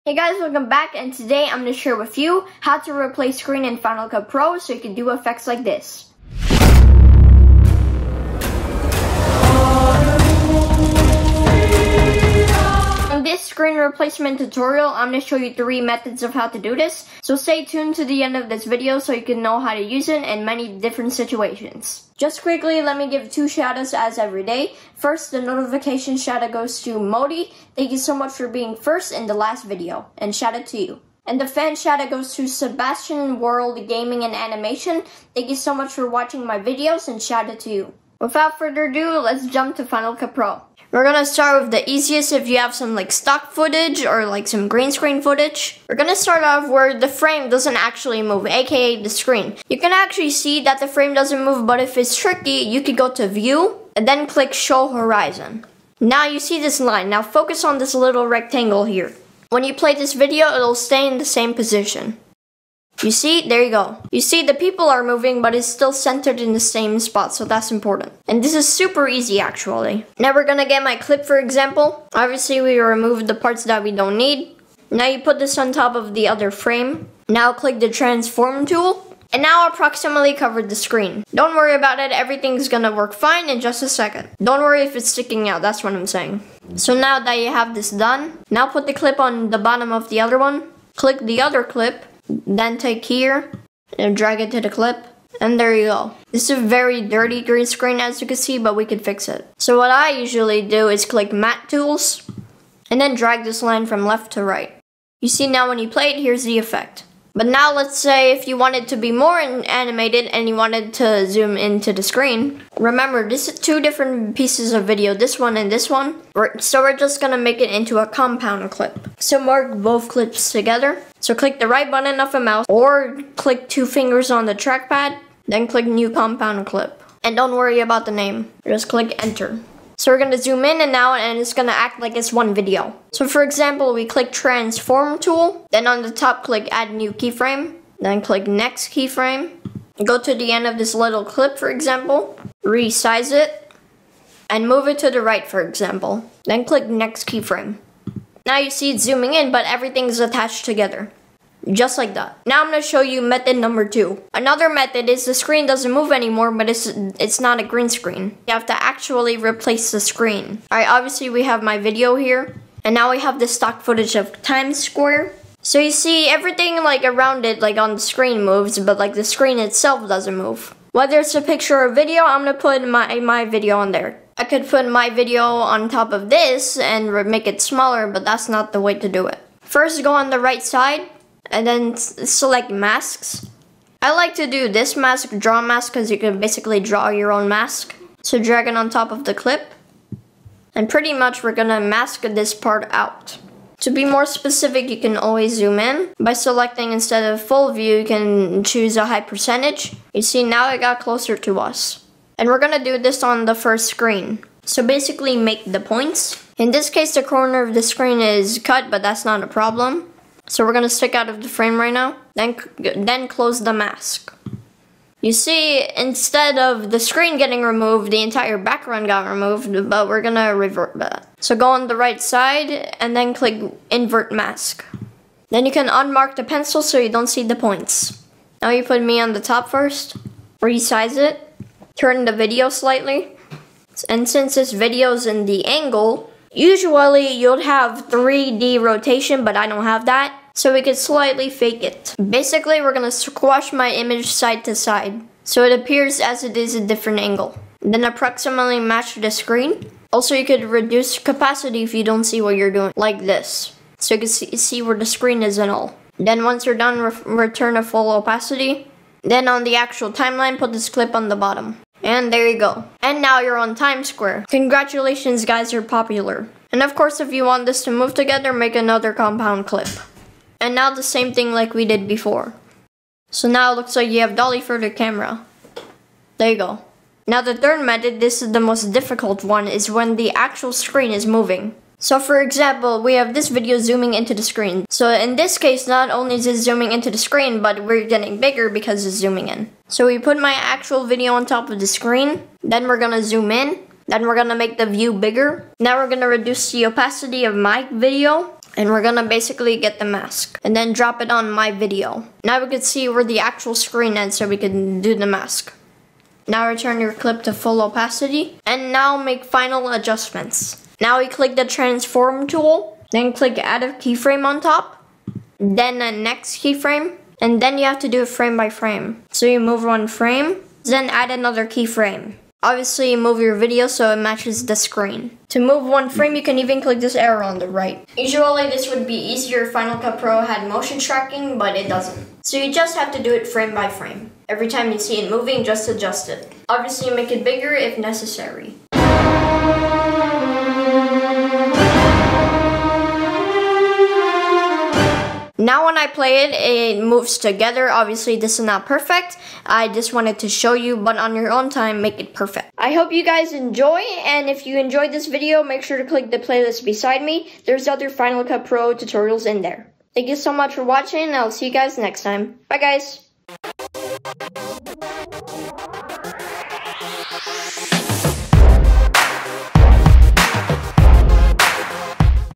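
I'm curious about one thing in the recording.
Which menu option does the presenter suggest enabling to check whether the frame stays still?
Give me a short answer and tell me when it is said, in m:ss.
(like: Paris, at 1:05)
Show horizon, at 0:54.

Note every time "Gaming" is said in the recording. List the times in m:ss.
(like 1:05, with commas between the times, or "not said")
0:33.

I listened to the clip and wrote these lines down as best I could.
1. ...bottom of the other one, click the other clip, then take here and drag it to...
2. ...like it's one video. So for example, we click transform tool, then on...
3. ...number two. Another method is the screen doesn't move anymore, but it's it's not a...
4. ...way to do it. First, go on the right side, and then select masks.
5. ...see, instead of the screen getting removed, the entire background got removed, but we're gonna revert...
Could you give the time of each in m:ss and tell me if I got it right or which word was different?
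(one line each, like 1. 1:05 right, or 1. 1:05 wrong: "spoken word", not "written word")
1. 1:29 right
2. 2:11 right
3. 2:33 right
4. 2:58 right
5. 3:35 right.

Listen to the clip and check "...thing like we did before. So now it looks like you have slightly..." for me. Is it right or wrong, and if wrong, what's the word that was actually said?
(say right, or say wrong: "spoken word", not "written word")
wrong: "dolly", not "slightly".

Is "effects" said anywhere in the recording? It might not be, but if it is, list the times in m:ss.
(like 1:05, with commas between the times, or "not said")
0:05, 1:46.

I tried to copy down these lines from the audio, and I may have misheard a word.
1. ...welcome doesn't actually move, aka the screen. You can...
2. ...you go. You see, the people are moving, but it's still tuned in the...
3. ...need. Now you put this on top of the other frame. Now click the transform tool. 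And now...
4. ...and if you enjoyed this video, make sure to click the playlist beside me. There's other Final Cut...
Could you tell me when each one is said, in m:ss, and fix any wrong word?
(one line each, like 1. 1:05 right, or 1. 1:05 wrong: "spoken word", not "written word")
1. 0:47 wrong: "frame", not "welcome"
2. 1:03 wrong: "centered", not "tuned"
3. 1:14 right
4. 5:54 right.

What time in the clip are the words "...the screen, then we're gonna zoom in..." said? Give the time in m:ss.
4:51.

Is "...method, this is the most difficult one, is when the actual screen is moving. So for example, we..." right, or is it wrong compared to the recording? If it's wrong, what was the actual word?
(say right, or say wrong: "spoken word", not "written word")
right.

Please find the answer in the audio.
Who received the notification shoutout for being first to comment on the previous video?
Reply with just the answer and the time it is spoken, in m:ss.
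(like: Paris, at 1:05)
Mody, at 0:26.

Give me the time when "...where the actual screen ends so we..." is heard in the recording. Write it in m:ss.
5:03.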